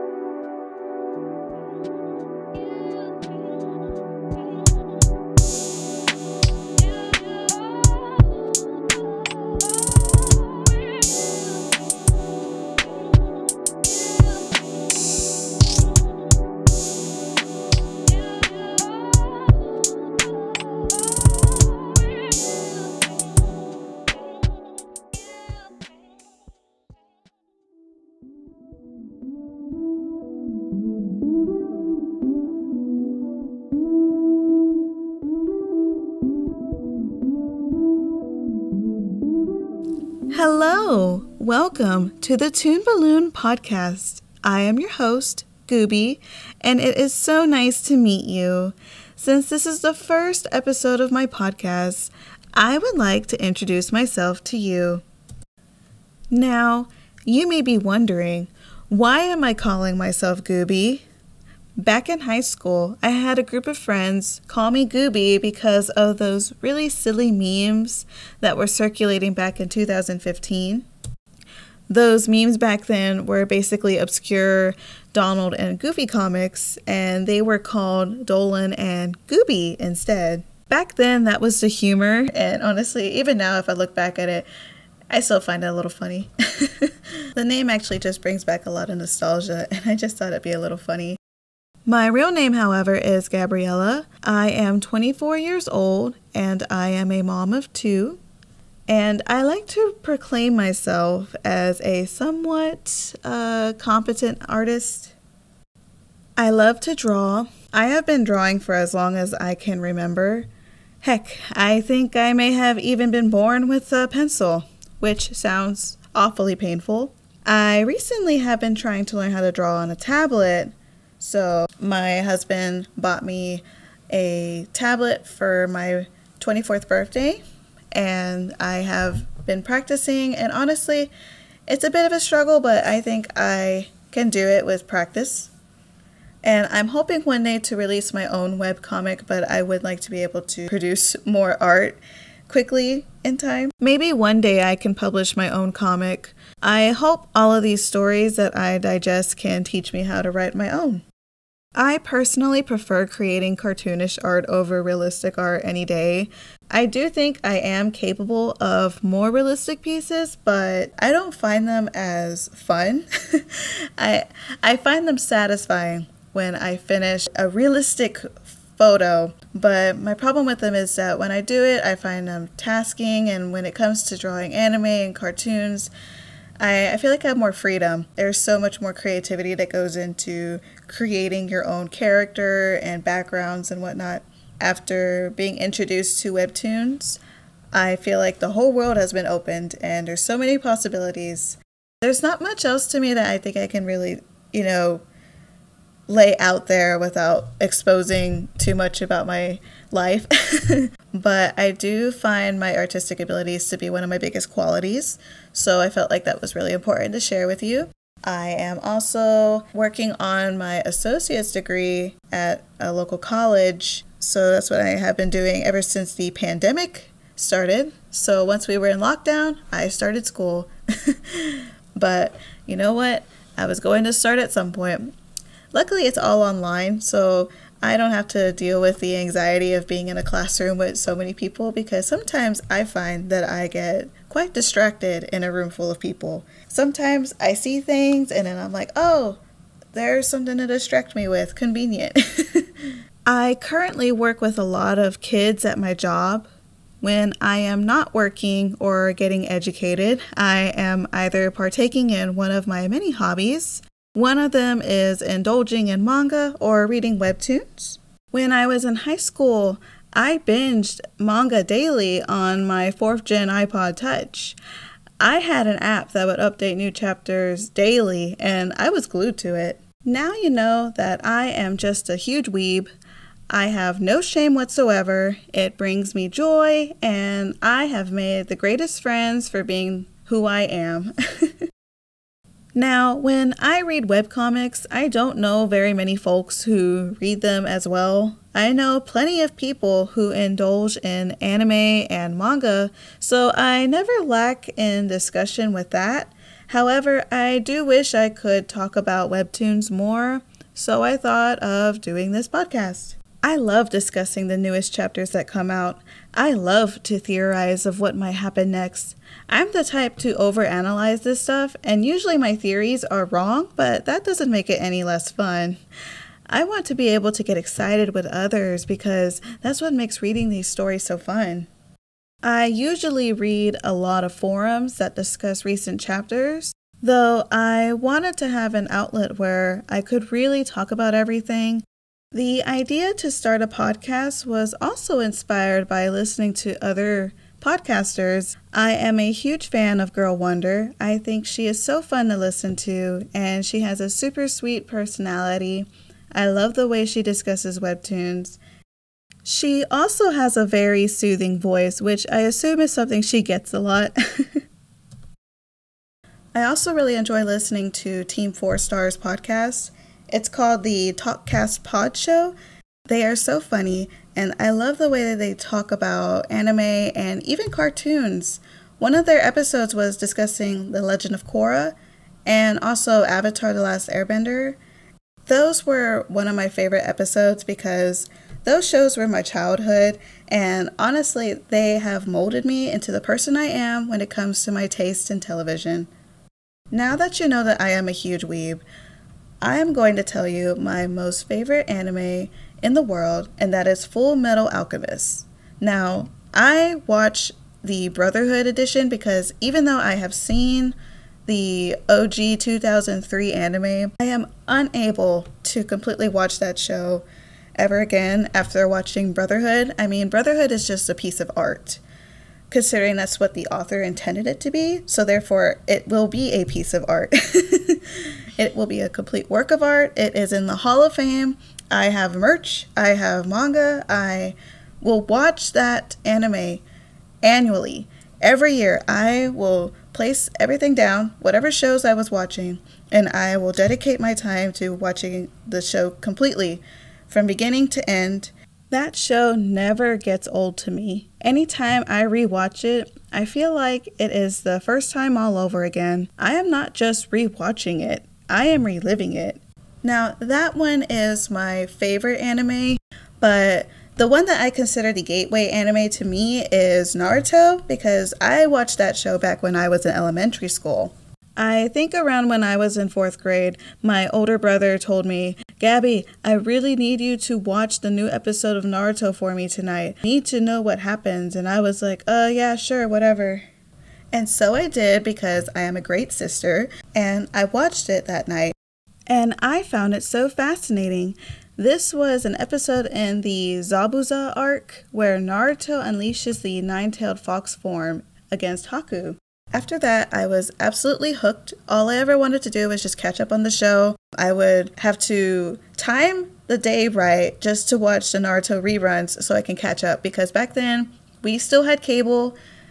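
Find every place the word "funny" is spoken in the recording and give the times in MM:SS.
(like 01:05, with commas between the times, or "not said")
01:25, 01:30, 06:03.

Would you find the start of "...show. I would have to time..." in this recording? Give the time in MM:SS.
08:13.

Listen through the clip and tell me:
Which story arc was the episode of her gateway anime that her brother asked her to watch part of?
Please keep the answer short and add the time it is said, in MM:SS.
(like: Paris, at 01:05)
Zabuza arc, at 08:03.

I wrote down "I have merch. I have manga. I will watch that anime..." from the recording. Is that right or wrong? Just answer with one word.
right.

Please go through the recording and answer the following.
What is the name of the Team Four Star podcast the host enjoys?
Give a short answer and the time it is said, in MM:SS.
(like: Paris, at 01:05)
Talkcast Pod Show, at 06:01.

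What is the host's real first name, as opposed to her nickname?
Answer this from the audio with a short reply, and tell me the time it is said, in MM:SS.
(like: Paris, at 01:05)
Gabriella, at 01:33.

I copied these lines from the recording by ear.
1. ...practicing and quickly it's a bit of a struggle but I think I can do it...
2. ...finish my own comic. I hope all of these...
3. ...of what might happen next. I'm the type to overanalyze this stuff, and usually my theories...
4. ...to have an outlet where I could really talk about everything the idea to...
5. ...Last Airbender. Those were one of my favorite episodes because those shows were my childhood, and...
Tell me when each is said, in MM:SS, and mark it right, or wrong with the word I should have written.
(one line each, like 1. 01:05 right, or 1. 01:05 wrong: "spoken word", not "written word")
1. 02:09 wrong: "honestly", not "quickly"
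2. 02:24 wrong: "publish", not "finish"
3. 05:07 right
4. 05:28 right
5. 06:13 right.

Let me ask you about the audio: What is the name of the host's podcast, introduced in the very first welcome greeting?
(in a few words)
Toon Balloon.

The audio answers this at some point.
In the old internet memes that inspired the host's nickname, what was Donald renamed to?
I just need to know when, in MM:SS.
01:18.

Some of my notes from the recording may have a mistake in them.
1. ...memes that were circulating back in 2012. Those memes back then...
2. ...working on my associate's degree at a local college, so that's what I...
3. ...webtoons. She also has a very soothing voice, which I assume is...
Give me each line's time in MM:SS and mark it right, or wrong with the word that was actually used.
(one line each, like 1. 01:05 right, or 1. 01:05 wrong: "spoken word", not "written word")
1. 01:07 wrong: "2015", not "2012"
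2. 03:29 right
3. 05:47 right.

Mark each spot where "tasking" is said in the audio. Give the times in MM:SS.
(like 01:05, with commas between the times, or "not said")
02:52.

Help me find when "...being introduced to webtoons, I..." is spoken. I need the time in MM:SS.
03:05.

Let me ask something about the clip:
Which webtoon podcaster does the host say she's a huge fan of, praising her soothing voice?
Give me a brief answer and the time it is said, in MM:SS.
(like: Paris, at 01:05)
Girl Wonder, at 05:40.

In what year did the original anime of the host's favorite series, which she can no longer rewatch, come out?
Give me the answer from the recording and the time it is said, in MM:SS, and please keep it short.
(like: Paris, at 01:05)
2003, at 06:42.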